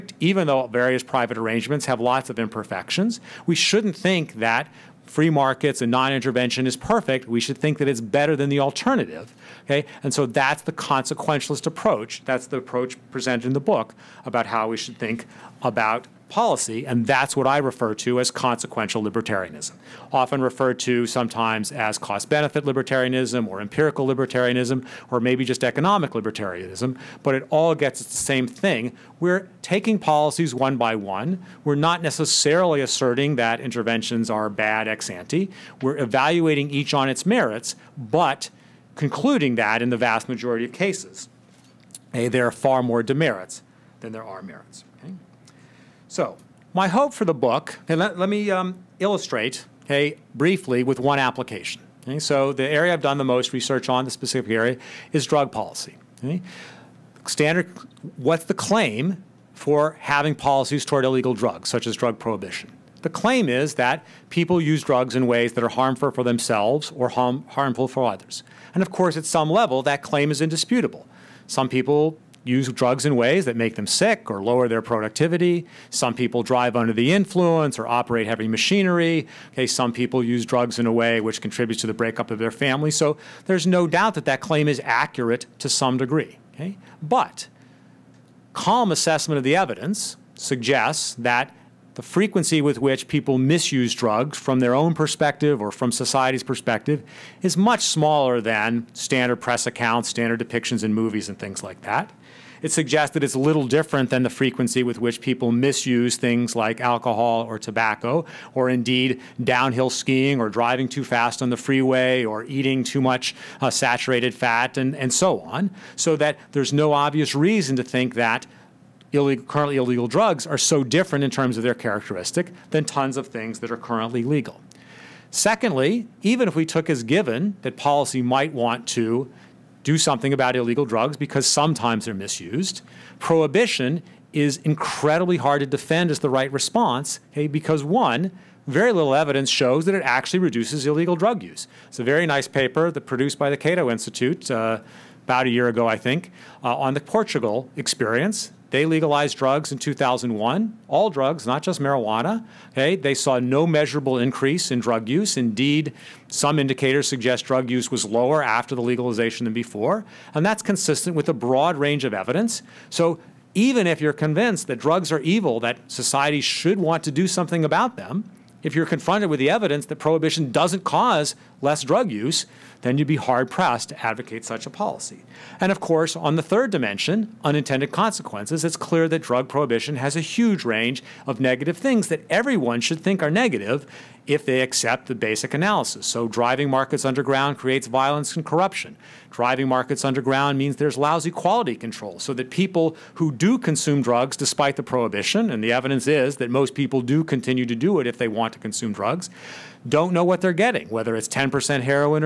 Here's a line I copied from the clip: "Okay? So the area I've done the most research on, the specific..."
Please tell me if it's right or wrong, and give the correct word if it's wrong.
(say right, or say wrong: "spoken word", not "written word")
right.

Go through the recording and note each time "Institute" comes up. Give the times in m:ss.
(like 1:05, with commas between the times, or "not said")
2:23.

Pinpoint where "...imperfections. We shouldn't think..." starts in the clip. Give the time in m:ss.
0:02.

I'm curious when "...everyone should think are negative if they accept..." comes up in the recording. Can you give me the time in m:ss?
3:02.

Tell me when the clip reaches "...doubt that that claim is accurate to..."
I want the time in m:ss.
1:23.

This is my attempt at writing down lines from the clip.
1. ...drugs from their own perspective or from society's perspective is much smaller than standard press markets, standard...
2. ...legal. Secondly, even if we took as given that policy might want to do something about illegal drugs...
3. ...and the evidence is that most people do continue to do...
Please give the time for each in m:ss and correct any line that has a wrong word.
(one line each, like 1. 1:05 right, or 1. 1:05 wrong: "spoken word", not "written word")
1. 1:33 wrong: "accounts", not "markets"
2. 2:04 right
3. 3:15 right.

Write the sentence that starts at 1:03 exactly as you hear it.
The claim is that people use drugs in ways that are harmful for themselves or harm, harmful for others.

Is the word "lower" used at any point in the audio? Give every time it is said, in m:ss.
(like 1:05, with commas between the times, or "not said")
1:14, 2:38.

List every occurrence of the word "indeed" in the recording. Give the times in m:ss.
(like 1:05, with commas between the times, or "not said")
1:48, 2:35.